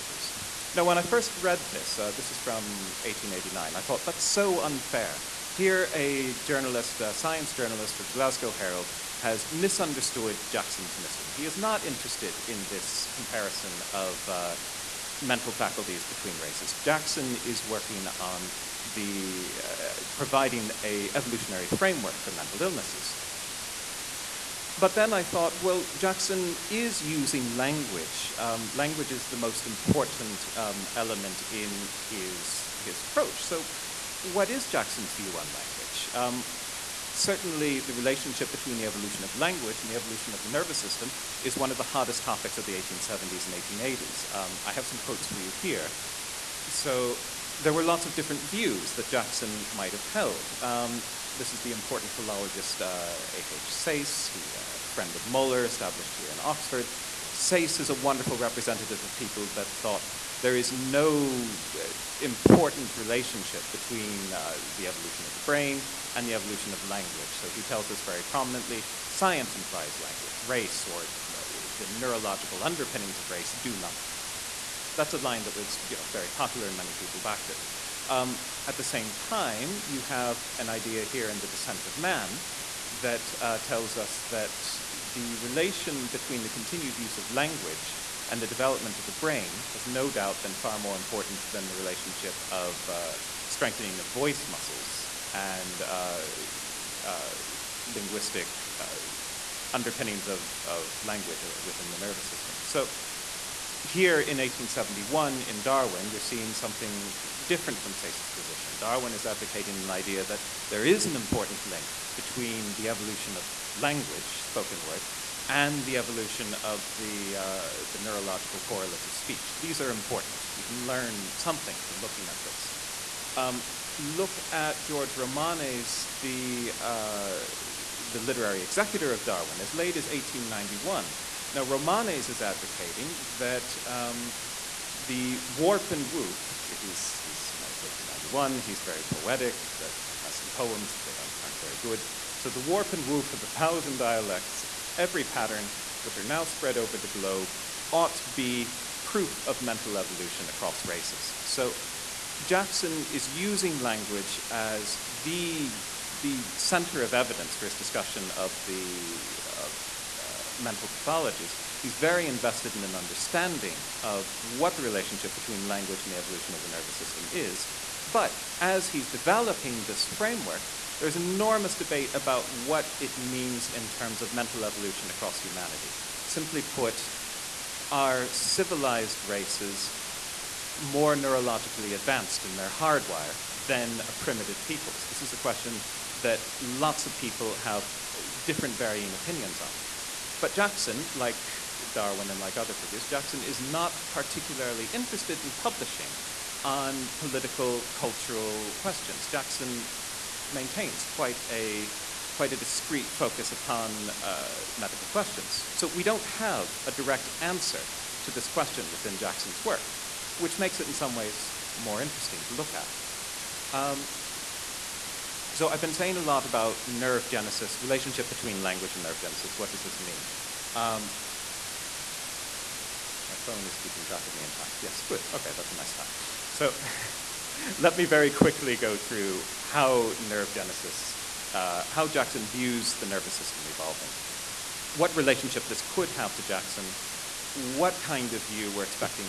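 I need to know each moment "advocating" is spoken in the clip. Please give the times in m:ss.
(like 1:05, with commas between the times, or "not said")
1:49, 2:12.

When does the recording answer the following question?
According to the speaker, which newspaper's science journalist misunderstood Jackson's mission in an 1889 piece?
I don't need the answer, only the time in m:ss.
0:08.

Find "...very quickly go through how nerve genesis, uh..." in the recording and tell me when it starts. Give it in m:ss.
3:48.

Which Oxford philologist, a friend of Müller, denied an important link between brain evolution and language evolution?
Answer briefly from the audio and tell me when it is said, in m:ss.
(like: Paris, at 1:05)
A.H. Sayce, at 0:53.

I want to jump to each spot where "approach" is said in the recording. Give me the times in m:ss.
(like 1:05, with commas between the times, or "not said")
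0:33.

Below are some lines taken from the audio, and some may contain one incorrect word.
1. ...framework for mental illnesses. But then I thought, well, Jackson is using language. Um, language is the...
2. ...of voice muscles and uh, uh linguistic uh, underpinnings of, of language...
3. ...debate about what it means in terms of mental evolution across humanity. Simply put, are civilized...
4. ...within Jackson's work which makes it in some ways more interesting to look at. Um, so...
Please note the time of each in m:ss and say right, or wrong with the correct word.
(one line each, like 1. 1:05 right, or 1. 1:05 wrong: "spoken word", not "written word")
1. 0:21 right
2. 1:33 right
3. 2:51 right
4. 3:28 right.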